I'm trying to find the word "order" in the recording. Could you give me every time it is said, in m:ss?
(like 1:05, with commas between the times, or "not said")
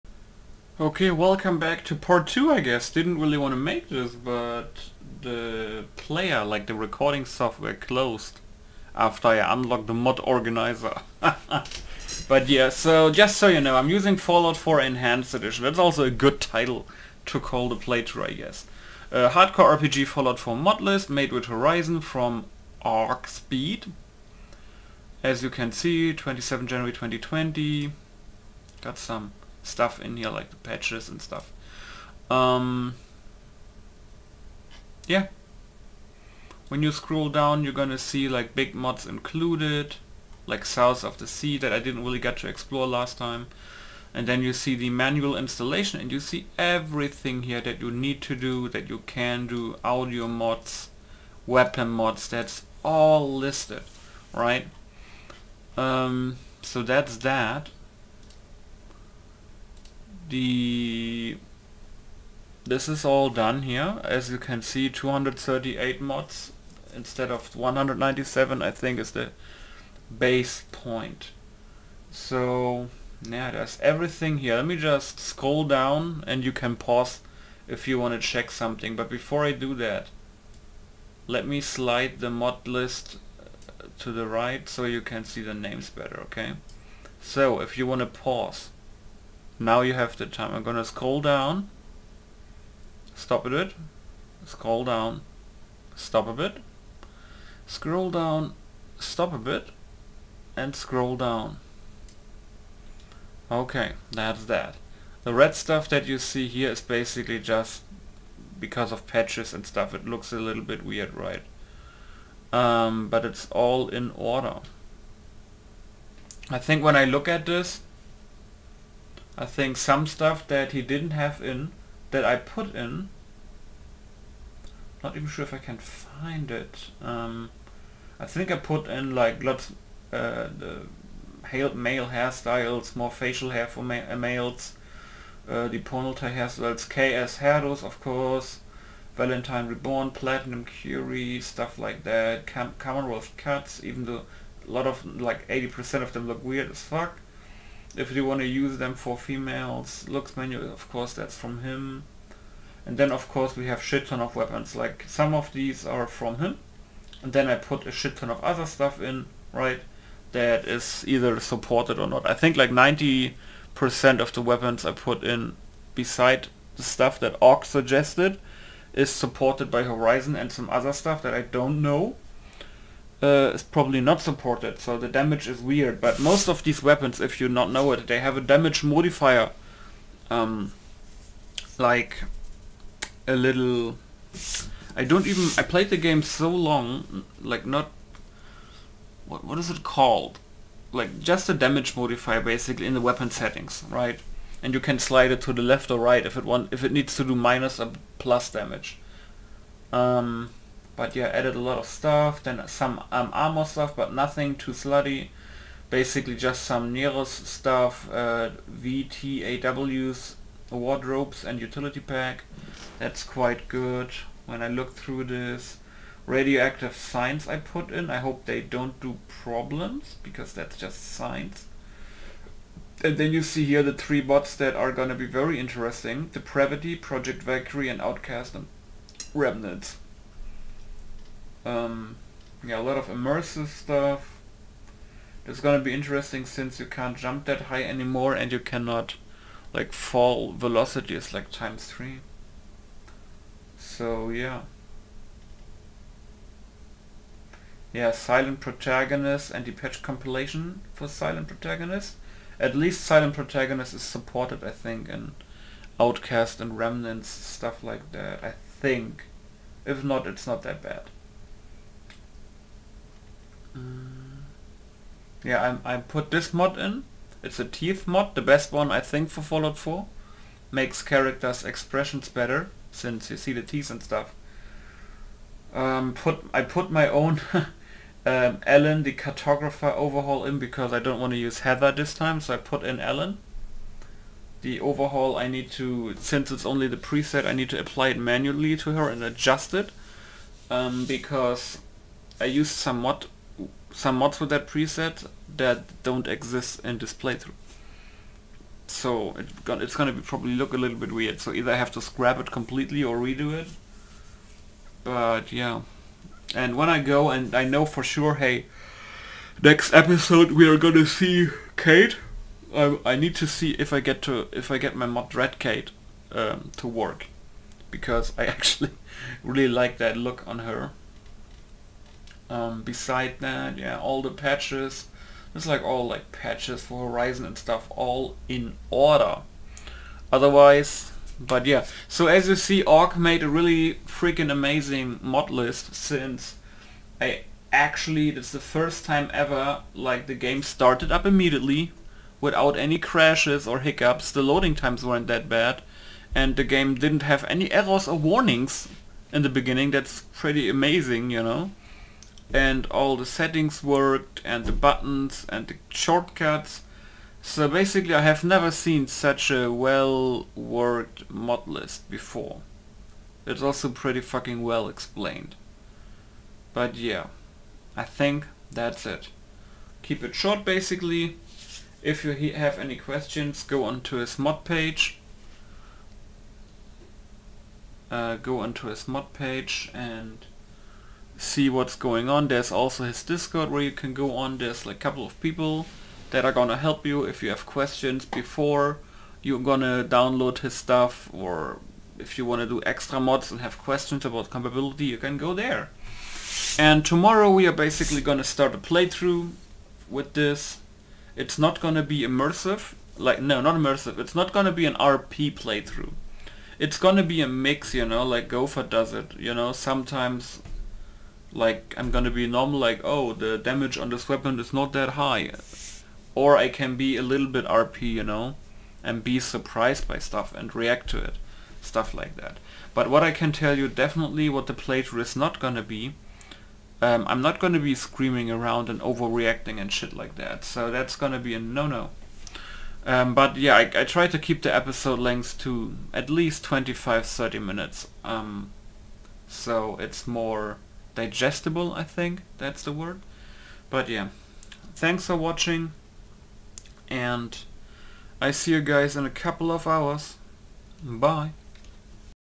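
1:54, 5:28.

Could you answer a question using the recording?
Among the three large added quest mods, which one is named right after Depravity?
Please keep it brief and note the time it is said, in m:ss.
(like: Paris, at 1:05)
Project Valkyrie, at 3:46.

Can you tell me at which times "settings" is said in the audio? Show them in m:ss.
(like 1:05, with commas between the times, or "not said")
3:13, 5:53.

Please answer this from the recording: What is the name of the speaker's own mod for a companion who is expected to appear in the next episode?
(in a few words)
Red Kate.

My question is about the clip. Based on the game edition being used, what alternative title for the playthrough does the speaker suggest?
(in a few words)
Fallout 4 Enhanced Edition.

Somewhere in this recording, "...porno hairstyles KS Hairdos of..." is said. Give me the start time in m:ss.
2:15.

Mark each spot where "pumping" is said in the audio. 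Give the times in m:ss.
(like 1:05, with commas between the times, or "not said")
not said.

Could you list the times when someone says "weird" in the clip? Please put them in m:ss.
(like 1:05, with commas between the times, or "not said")
1:50, 2:26, 2:55, 5:01.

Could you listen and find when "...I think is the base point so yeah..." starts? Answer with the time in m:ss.
1:08.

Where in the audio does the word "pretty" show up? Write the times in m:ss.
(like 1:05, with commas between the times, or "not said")
5:50, 6:03.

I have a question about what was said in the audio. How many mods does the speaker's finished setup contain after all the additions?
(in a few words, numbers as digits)
238.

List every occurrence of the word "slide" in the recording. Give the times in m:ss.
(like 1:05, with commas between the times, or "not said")
1:21, 3:14.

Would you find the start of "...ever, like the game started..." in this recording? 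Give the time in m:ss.
5:39.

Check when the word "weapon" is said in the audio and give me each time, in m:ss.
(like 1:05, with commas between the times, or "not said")
0:51, 2:34, 2:44, 2:56, 3:13, 6:54.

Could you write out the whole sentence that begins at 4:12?
At least Silent Protagonist is supported I think in Outcast and Remnants, stuff like that, I think.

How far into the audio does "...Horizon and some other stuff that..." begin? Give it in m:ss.
2:49.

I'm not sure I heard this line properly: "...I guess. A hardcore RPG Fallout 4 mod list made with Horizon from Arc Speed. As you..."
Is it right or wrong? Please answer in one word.
right.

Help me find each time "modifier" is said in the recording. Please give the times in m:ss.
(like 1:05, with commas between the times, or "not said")
2:58, 3:11.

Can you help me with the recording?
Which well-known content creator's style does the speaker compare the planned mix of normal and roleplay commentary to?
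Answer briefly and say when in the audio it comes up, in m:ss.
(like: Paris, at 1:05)
Gopher, at 6:48.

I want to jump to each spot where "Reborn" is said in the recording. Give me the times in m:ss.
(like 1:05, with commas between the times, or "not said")
2:19.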